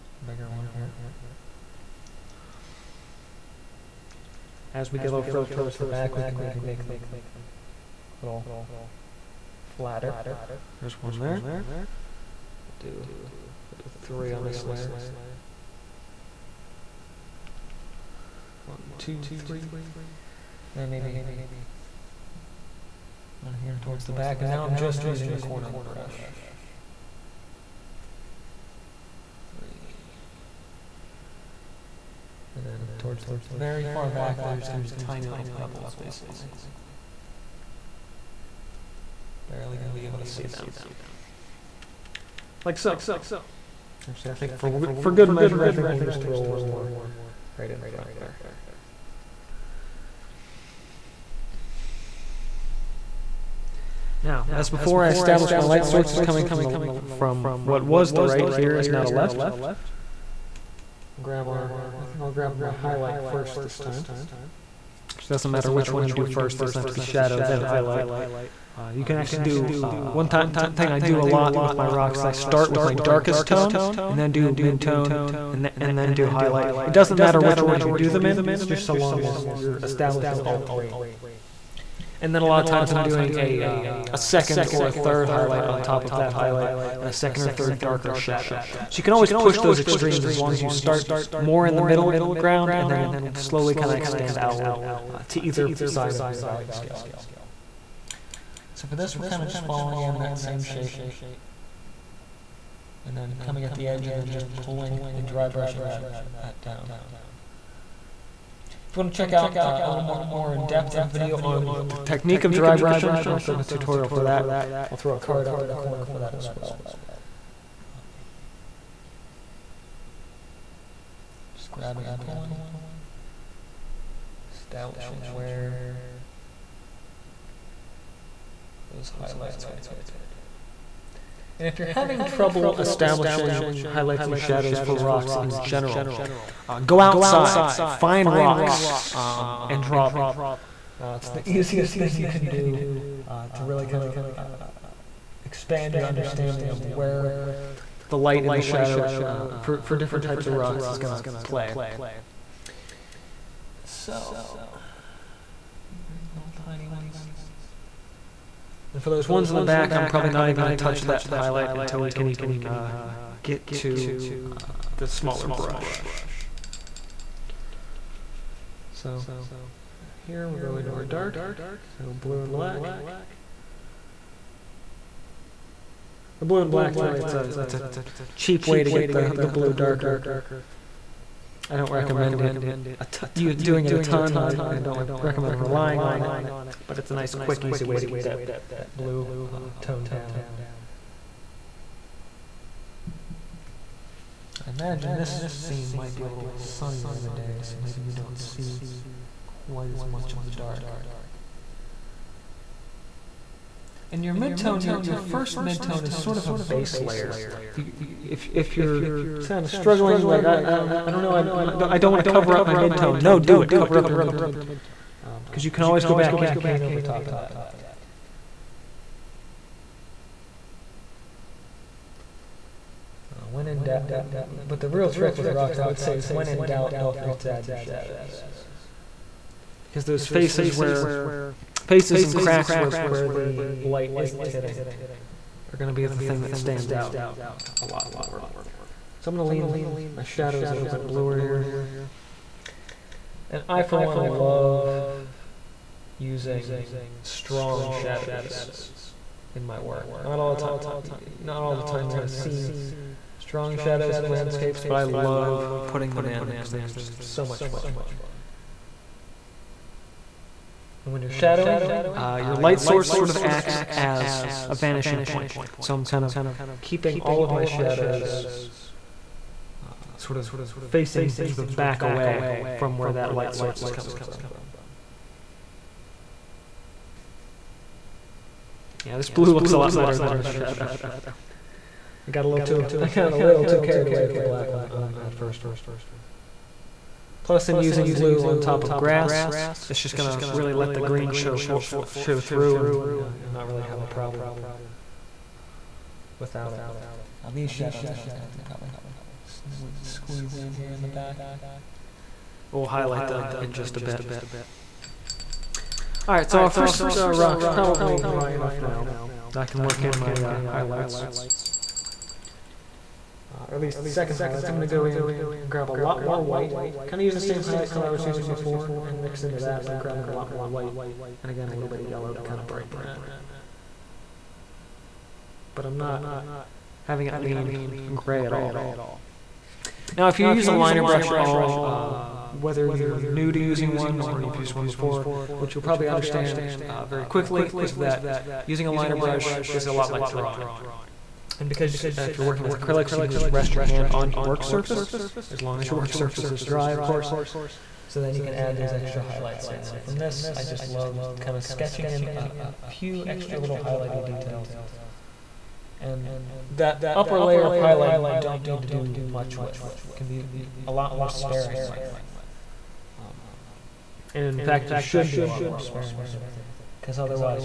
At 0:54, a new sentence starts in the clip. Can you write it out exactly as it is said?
Now, as before, I established my light source is coming from the from what was the right here is now the left.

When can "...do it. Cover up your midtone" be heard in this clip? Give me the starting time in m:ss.
3:33.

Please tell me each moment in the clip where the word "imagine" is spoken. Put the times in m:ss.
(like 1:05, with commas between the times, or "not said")
3:14.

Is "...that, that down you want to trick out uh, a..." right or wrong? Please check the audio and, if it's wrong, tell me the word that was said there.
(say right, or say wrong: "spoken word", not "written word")
wrong: "check", not "trick".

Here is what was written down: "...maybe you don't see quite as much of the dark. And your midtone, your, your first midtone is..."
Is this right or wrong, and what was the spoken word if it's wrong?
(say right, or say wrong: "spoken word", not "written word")
right.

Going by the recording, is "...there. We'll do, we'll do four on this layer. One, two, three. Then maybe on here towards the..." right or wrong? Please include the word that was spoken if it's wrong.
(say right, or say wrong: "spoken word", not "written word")
wrong: "three", not "four".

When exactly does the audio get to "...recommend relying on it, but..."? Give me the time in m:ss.
3:05.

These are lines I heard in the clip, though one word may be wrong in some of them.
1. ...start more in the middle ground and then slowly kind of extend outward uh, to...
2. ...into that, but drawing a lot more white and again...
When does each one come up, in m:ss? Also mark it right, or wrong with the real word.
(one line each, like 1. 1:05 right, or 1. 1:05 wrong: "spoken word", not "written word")
1. 1:30 right
2. 5:19 wrong: "grabbing", not "drawing".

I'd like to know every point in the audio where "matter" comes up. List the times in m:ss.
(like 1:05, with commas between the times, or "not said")
1:05, 1:17.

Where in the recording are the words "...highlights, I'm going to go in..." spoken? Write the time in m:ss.
5:14.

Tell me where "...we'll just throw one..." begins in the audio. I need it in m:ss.
0:45.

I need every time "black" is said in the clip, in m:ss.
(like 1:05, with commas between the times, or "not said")
2:52, 2:56, 4:44.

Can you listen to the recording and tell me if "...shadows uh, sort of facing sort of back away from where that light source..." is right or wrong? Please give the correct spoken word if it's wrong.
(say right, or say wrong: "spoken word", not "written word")
right.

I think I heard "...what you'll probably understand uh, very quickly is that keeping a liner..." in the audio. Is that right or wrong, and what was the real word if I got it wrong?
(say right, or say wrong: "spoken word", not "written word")
wrong: "using", not "keeping".